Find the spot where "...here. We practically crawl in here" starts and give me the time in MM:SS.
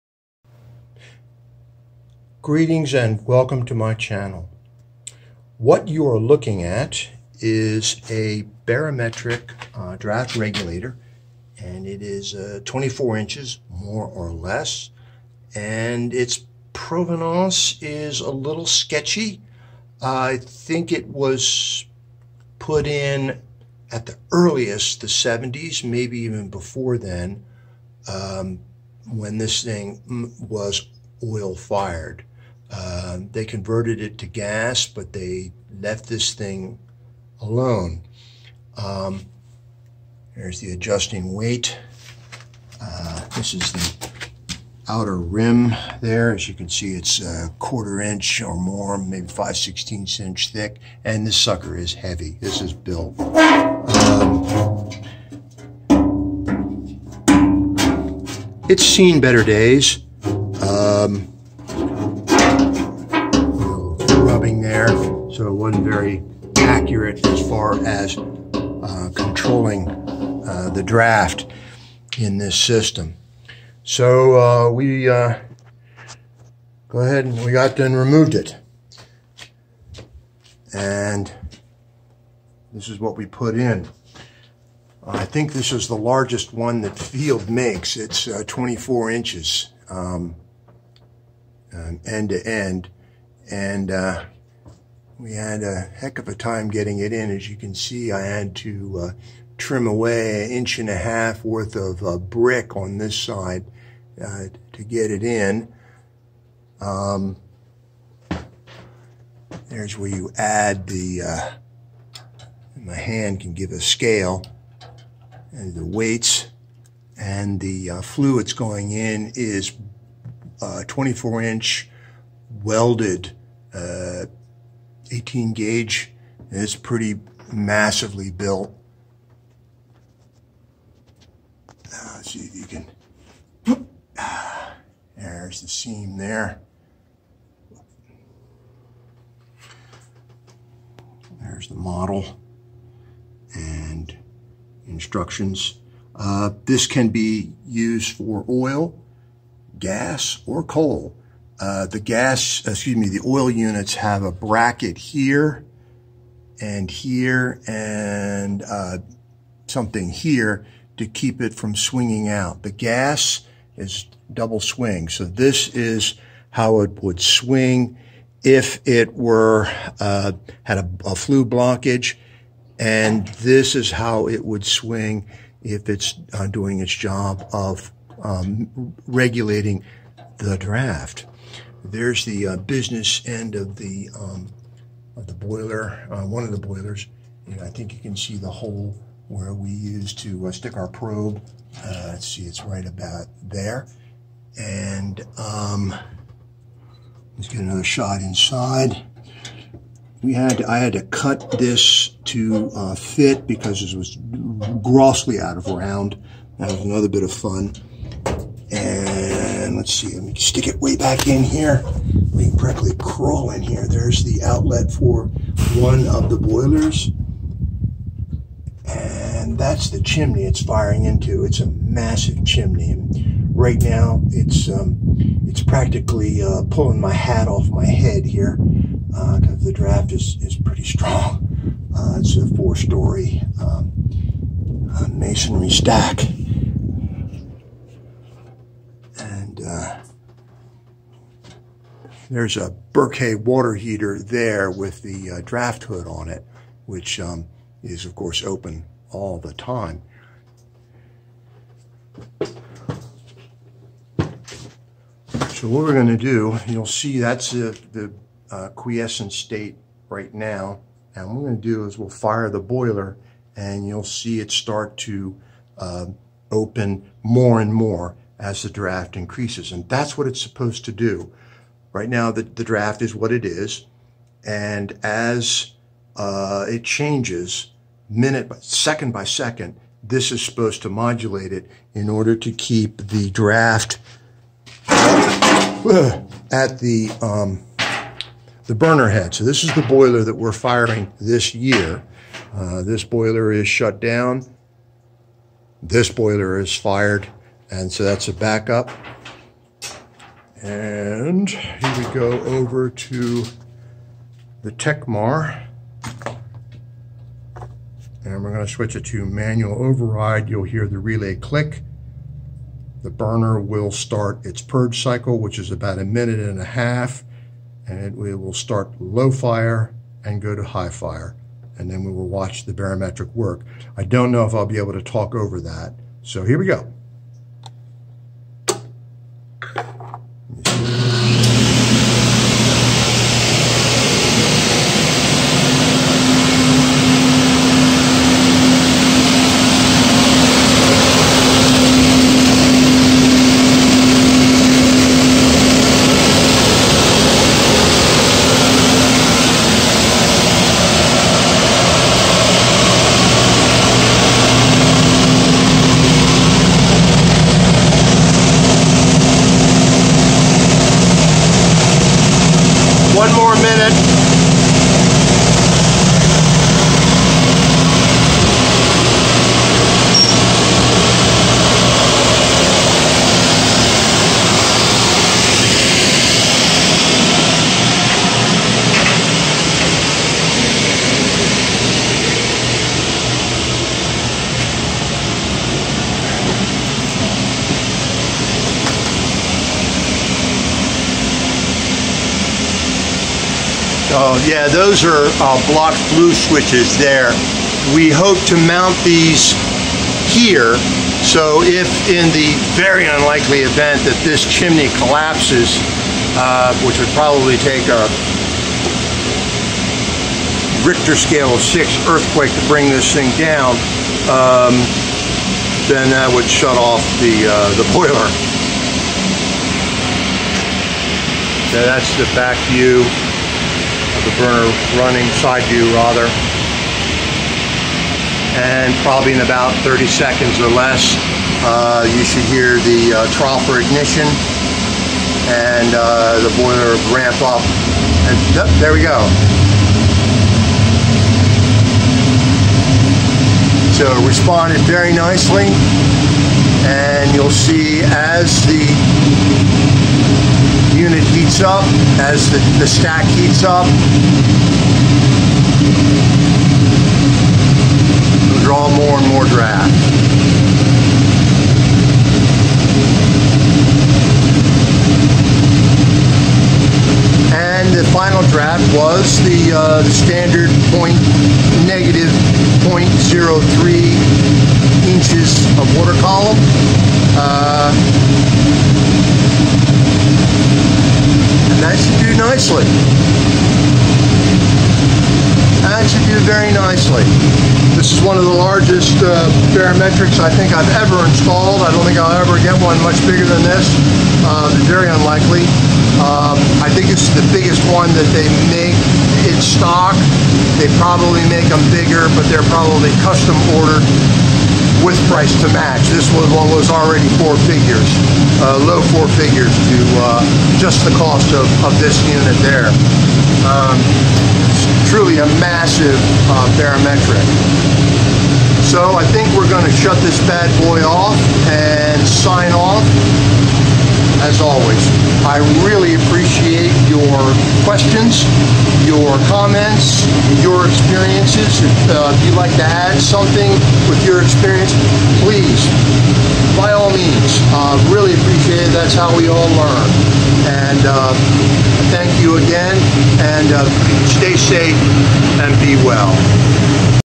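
03:31.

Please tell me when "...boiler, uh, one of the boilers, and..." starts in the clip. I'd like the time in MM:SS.
03:05.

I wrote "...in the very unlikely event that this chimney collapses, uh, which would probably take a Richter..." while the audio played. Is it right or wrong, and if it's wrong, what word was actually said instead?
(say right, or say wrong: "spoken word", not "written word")
right.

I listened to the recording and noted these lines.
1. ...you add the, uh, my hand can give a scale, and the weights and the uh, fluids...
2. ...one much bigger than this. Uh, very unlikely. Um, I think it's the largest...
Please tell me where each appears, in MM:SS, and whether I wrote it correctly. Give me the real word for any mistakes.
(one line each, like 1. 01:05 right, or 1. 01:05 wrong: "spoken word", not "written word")
1. 01:50 right
2. 08:12 wrong: "biggest", not "largest".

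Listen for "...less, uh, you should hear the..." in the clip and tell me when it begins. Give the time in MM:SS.
07:10.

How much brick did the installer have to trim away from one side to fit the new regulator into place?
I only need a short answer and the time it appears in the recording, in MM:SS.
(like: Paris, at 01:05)
1.5 inches, at 01:40.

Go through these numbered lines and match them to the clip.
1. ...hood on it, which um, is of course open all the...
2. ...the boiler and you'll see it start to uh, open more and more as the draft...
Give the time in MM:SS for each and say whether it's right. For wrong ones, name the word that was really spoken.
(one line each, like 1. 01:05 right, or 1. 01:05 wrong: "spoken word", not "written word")
1. 04:05 right
2. 04:22 right.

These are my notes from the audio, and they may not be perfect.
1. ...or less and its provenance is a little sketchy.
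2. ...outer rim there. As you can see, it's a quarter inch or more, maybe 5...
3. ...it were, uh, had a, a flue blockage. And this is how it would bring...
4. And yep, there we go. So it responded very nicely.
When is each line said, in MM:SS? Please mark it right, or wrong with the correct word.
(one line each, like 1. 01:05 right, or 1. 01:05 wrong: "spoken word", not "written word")
1. 00:14 right
2. 00:44 right
3. 02:48 wrong: "swing", not "bring"
4. 07:18 right.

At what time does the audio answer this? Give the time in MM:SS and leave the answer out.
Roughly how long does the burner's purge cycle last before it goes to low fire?
05:15.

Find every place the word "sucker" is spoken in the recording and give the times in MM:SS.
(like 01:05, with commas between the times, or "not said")
00:51.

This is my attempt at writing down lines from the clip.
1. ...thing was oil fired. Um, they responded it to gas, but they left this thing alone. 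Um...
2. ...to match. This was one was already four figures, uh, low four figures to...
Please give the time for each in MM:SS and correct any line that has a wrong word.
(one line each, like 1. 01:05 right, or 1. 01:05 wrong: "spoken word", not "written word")
1. 00:29 wrong: "converted", not "responded"
2. 08:25 right.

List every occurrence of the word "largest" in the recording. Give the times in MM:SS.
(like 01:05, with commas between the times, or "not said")
01:25, 08:08.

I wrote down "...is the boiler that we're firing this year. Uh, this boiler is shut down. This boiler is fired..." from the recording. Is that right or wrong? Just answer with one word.
right.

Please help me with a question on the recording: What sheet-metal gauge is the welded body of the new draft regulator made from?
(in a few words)
18 gauge.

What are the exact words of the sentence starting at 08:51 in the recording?
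If uh, you'd like to add something with your experience, please, by all means, uh, really appreciate it.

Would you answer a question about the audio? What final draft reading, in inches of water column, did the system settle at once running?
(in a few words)
-0.03 inches.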